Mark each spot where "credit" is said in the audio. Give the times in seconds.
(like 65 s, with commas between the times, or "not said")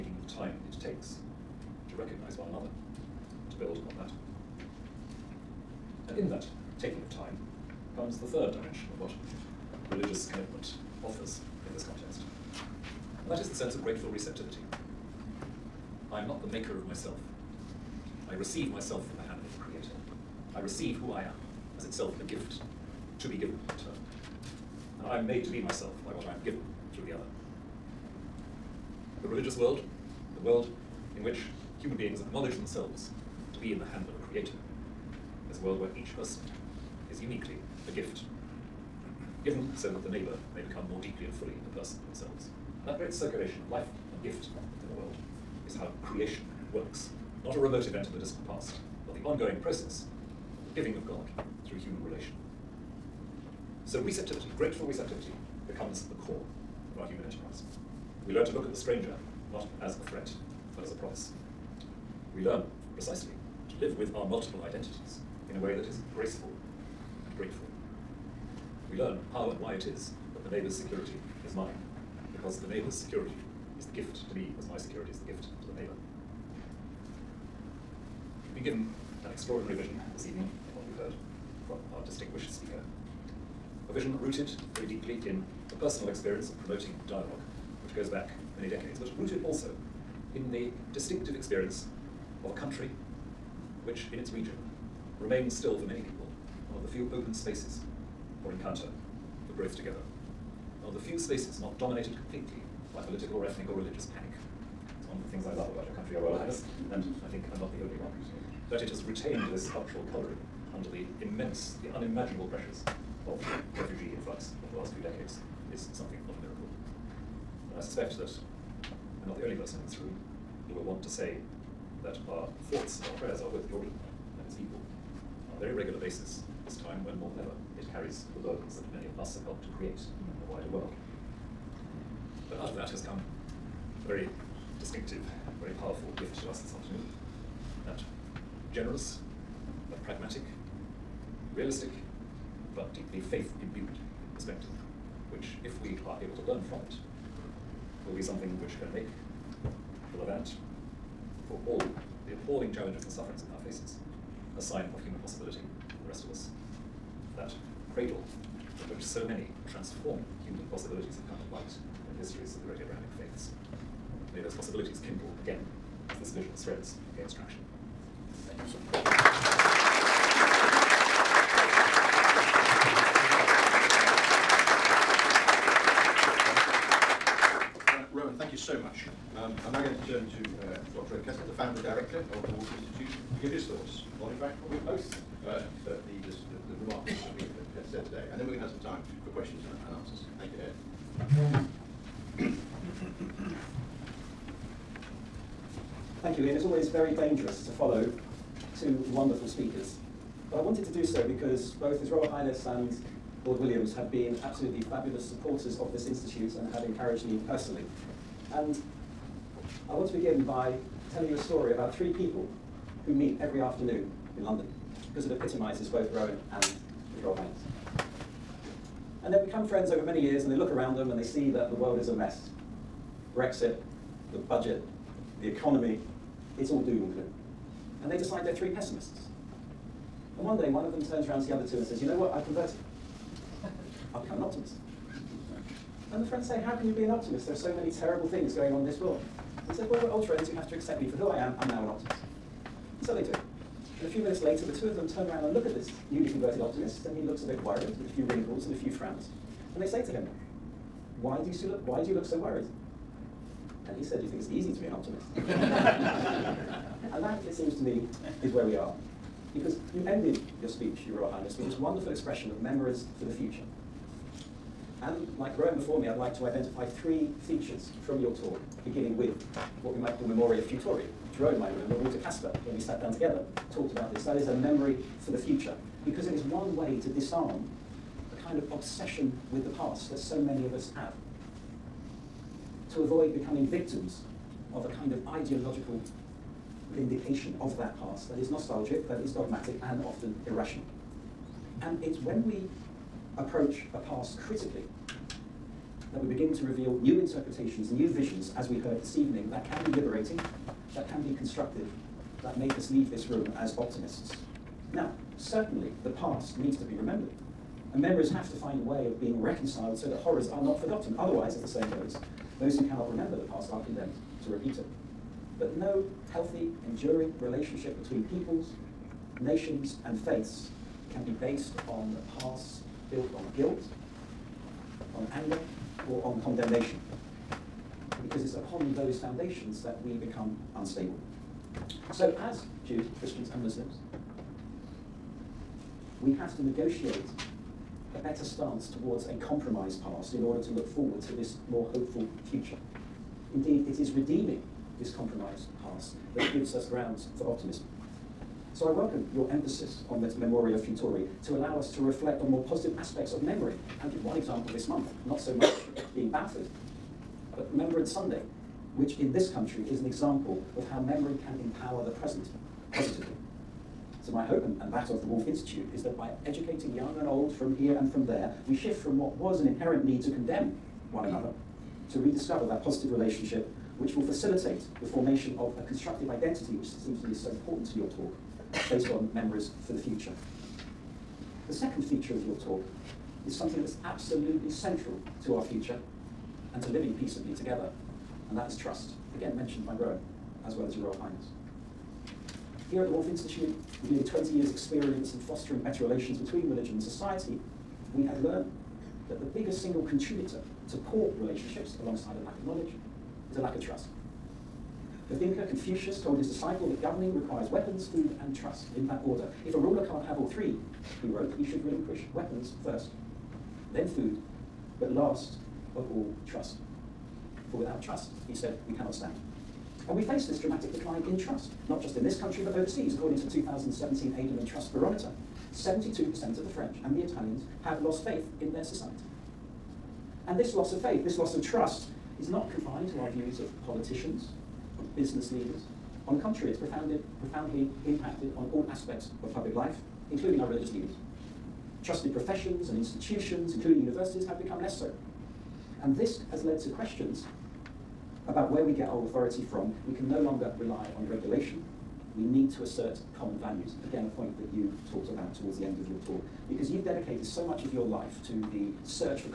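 not said.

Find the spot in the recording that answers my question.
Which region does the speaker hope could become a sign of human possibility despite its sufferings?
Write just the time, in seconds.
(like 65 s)
149 s.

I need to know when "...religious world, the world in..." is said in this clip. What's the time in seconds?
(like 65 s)
29 s.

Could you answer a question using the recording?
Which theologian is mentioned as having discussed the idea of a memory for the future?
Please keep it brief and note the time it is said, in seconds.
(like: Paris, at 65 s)
Walter Kasper, at 271 s.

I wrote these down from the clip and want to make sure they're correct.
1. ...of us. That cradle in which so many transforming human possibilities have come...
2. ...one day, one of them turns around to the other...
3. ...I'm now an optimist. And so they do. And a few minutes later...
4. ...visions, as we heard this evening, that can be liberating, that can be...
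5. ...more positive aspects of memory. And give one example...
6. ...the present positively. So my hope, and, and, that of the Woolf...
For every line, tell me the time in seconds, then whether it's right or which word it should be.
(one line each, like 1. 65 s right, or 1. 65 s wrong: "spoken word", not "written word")
1. 156 s right
2. 230 s right
3. 241 s right
4. 298 s right
5. 352 s right
6. 362 s right.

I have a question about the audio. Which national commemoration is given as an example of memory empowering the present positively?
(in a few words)
Remembrance Sunday.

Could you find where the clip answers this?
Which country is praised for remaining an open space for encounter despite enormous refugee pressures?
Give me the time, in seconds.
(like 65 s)
123 s.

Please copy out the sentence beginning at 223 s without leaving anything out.
Brexit, the budget, the economy, it's all doom and gloom.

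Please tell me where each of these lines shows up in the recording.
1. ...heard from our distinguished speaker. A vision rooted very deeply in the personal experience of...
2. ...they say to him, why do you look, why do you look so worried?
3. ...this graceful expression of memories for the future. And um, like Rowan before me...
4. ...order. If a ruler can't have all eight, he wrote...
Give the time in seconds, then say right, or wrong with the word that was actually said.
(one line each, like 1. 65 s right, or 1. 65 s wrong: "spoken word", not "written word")
1. 80 s right
2. 249 s right
3. 261 s wrong: "wonderful", not "graceful"
4. 409 s wrong: "three", not "eight".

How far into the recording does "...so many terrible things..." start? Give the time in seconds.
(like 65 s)
237 s.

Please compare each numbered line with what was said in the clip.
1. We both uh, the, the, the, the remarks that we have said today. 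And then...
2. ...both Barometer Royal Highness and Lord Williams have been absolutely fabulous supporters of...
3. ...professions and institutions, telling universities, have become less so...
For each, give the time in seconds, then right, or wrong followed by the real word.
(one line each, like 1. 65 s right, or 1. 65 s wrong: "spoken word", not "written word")
1. 184 s right
2. 201 s wrong: "His", not "Barometer"
3. 442 s wrong: "including", not "telling".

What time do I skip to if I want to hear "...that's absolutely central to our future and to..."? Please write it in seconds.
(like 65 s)
383 s.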